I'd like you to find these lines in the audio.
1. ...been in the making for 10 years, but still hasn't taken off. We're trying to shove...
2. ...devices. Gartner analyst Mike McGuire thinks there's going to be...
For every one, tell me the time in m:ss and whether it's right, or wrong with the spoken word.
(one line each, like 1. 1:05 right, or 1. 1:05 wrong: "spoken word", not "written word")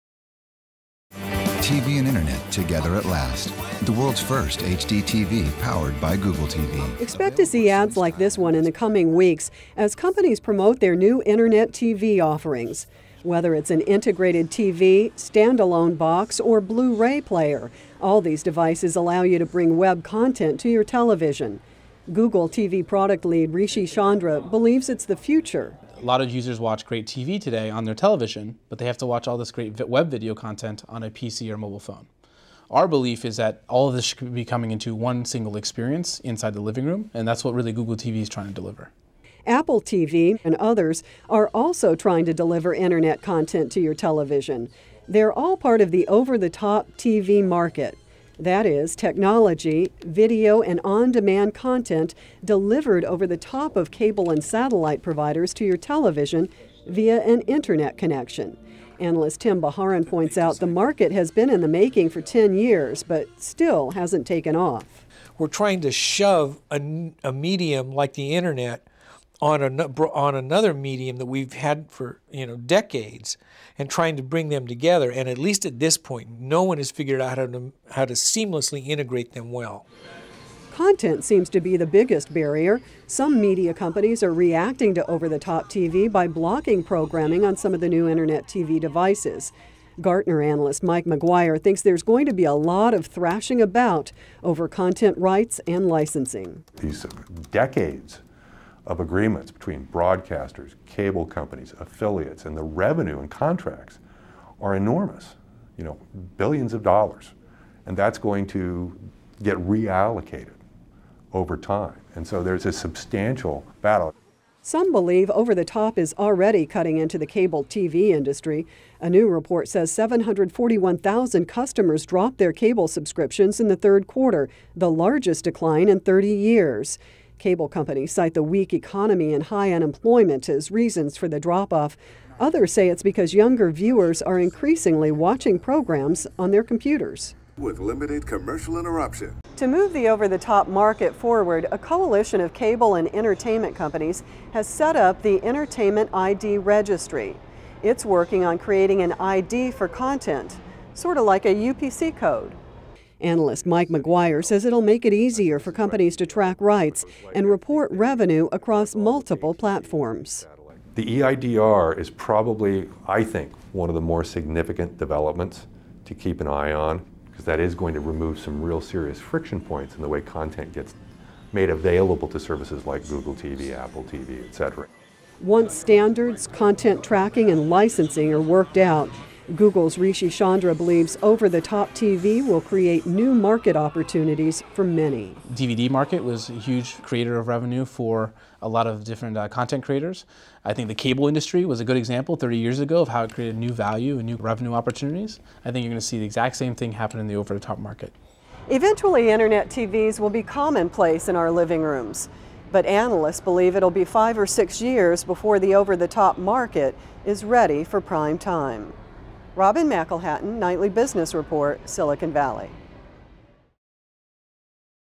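1. 1:01 right
2. 1:28 right.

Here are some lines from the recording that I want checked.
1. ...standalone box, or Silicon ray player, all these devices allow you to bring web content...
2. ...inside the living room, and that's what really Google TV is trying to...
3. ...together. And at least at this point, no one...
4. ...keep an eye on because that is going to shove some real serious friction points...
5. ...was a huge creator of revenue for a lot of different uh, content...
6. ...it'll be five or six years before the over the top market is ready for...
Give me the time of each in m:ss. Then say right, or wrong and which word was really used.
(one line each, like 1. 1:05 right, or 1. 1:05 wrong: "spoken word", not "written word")
1. 0:15 wrong: "Blu", not "Silicon"
2. 0:36 right
3. 1:14 right
4. 2:46 wrong: "remove", not "shove"
5. 3:06 right
6. 3:23 right.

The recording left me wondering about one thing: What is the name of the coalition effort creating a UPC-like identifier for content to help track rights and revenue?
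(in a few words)
Entertainment ID Registry.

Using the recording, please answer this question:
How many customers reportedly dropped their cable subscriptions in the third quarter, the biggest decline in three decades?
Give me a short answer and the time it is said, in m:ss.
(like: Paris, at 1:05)
741,000, at 1:59.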